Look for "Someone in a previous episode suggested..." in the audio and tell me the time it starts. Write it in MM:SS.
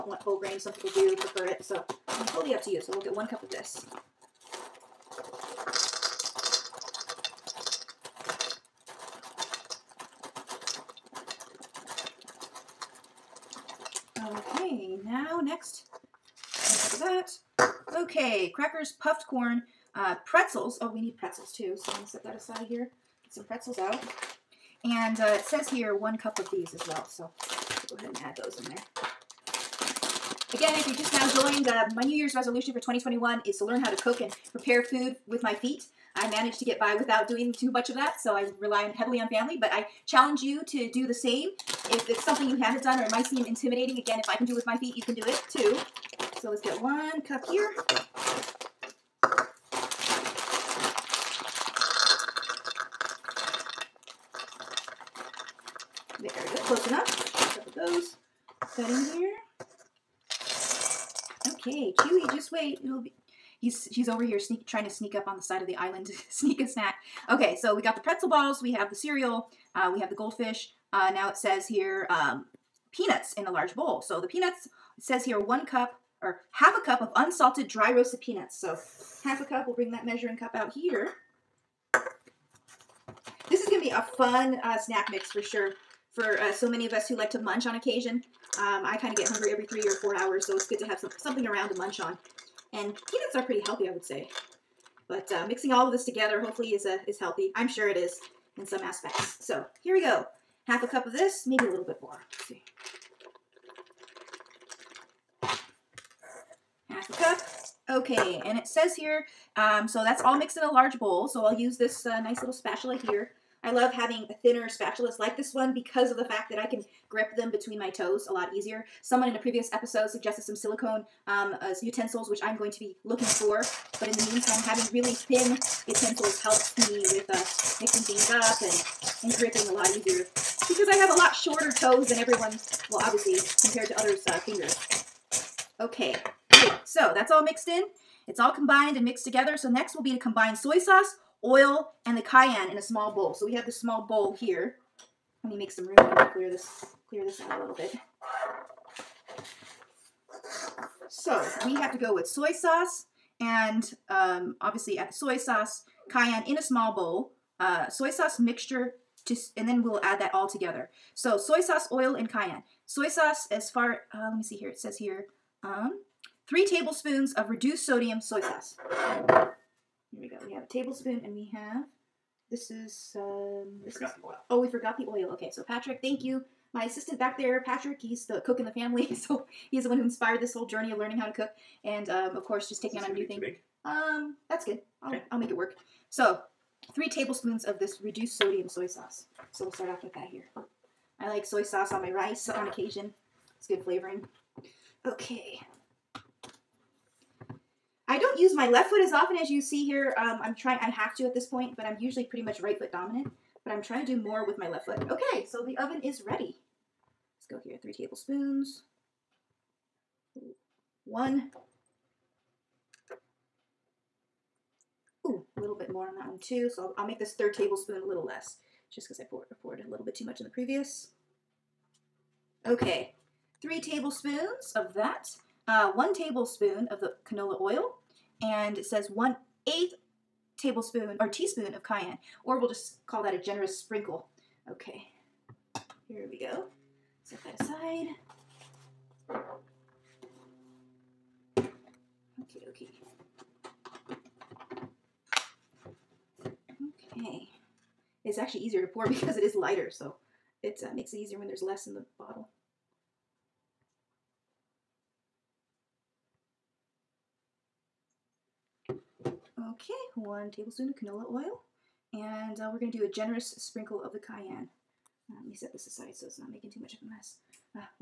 01:59.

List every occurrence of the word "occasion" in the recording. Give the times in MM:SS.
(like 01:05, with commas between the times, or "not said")
01:27, 03:12.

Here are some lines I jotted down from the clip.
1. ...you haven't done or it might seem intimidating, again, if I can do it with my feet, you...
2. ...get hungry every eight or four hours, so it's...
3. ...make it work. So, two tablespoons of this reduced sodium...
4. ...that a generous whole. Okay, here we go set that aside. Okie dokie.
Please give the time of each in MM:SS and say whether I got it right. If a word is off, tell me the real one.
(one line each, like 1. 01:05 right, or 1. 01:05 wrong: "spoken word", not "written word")
1. 00:42 right
2. 01:29 wrong: "three", not "eight"
3. 03:05 wrong: "three", not "two"
4. 03:53 wrong: "sprinkle", not "whole".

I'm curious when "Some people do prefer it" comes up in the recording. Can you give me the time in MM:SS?
00:00.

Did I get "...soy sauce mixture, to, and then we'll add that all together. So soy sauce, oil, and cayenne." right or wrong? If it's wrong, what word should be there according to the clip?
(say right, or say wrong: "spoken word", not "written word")
right.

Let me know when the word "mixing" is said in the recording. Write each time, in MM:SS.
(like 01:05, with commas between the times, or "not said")
01:35, 02:07.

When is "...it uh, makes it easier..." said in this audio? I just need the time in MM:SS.
04:10.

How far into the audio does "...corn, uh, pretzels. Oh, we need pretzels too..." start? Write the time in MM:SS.
00:19.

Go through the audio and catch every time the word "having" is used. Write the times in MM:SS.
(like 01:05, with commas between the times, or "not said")
01:53, 02:04.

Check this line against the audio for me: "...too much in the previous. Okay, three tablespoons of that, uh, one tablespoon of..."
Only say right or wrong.
right.